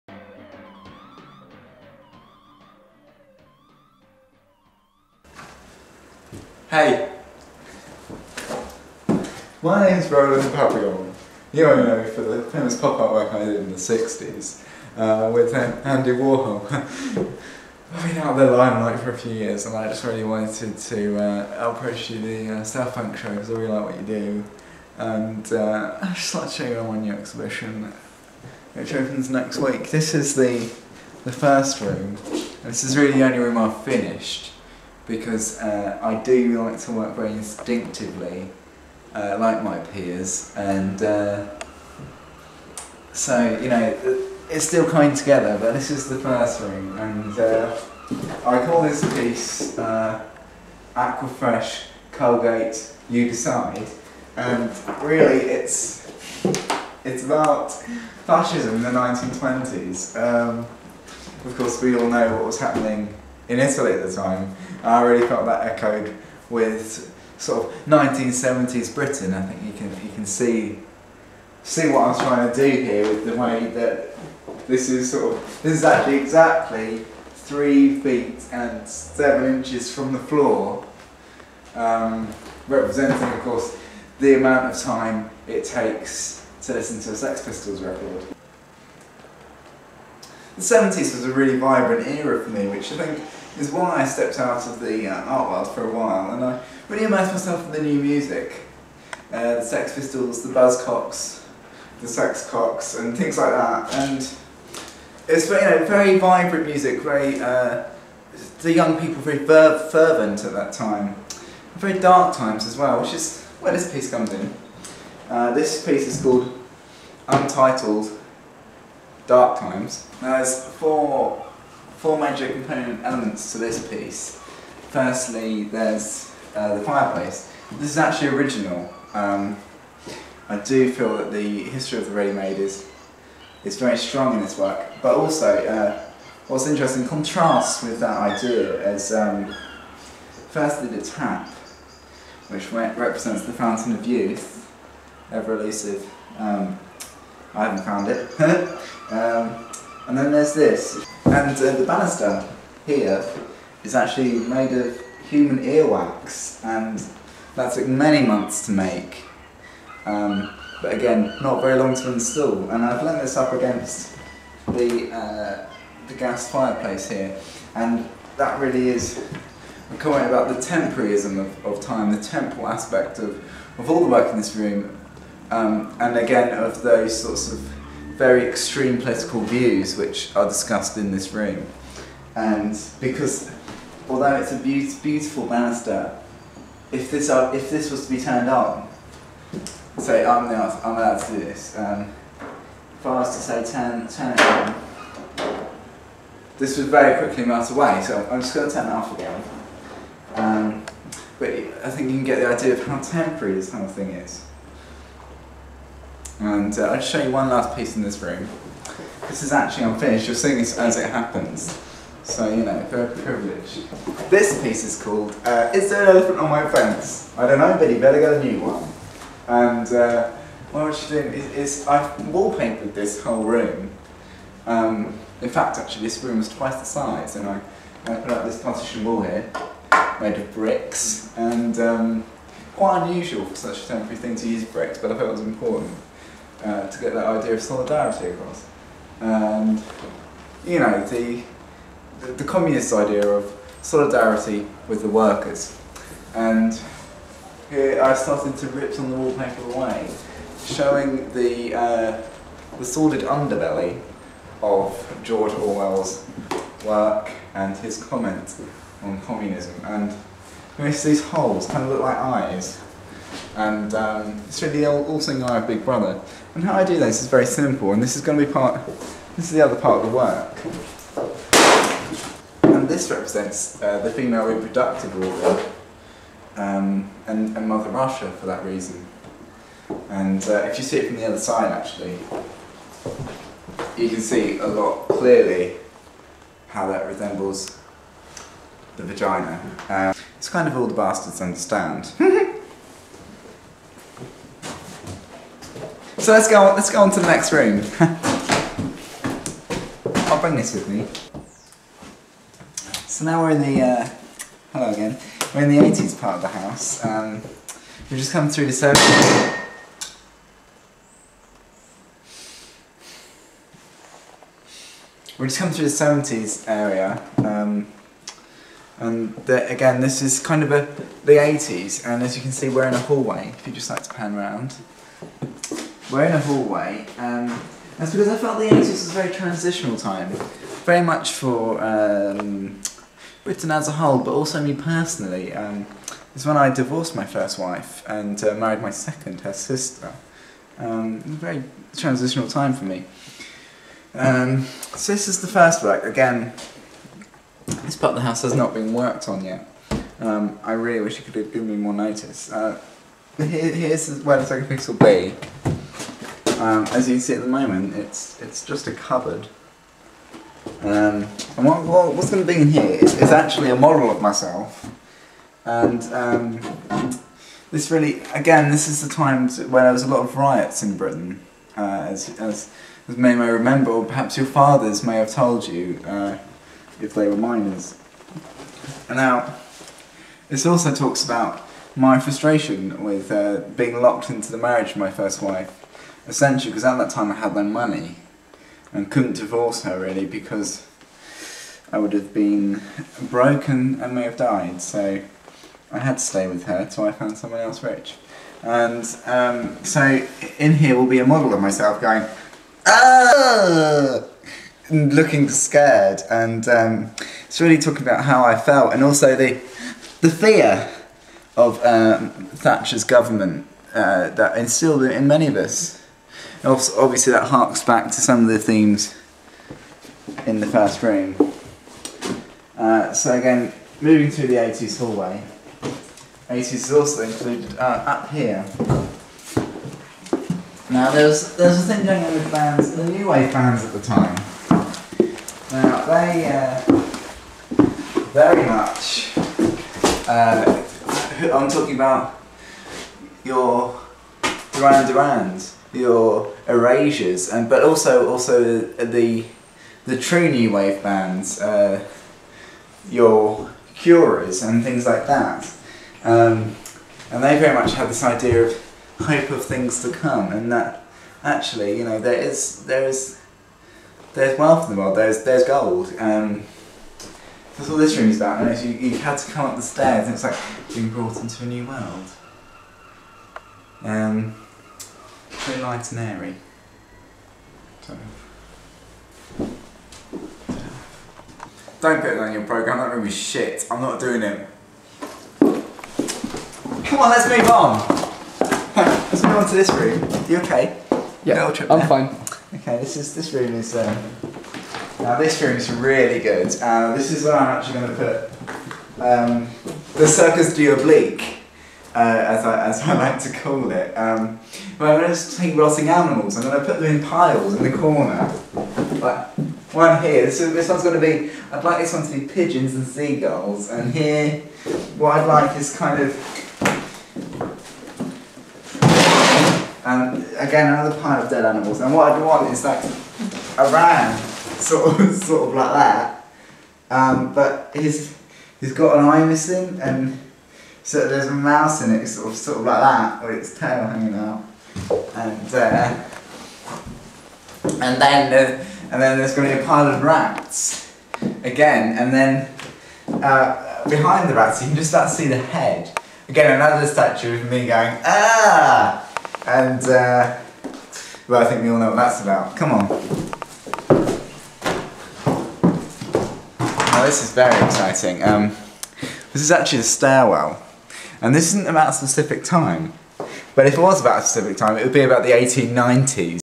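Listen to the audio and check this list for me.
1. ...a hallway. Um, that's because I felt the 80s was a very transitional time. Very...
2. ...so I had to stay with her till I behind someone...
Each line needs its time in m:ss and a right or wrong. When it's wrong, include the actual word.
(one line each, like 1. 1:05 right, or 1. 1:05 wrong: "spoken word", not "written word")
1. 5:26 right
2. 6:34 wrong: "found", not "behind".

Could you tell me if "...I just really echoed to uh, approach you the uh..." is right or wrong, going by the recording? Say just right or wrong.
wrong.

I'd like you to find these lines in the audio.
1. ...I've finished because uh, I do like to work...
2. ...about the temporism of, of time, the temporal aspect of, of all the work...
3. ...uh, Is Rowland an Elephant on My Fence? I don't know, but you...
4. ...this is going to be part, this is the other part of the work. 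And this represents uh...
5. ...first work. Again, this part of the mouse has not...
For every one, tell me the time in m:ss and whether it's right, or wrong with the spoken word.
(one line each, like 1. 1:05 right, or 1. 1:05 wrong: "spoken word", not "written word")
1. 0:33 right
2. 2:50 right
3. 3:35 wrong: "There", not "Rowland"
4. 4:28 right
5. 5:45 wrong: "house", not "mouse".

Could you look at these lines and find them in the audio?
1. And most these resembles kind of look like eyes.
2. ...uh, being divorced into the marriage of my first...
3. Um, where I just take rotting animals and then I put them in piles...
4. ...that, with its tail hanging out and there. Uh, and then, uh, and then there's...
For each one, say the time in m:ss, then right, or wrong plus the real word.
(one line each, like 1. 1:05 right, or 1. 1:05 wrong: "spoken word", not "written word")
1. 4:19 wrong: "holes", not "resembles"
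2. 6:23 wrong: "locked", not "divorced"
3. 8:24 right
4. 8:53 right.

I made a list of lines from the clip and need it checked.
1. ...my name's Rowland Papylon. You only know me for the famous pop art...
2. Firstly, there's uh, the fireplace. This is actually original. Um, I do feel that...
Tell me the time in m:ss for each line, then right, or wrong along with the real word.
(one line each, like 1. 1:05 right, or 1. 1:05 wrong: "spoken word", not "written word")
1. 0:09 right
2. 2:04 right.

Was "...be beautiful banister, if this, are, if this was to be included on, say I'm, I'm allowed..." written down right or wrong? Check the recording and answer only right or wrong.
wrong.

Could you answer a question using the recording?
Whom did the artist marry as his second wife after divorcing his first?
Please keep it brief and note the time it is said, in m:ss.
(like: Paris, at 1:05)
her sister, at 5:39.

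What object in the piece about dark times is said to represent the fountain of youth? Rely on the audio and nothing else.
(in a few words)
the tap.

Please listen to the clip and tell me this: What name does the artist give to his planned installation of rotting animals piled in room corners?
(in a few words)
Circus du Oblique.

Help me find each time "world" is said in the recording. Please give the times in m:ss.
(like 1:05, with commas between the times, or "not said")
1:35, 7:45, 7:51.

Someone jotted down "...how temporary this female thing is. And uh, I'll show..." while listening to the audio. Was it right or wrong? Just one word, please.
wrong.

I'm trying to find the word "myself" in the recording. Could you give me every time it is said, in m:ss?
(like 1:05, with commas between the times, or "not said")
1:37, 6:04, 6:41.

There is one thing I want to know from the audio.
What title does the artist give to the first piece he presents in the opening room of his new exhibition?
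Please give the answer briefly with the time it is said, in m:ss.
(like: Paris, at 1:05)
Aquafresh Colgate, at 0:50.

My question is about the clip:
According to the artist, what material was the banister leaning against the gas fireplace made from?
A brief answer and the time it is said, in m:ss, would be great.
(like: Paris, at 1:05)
human earwax, at 2:35.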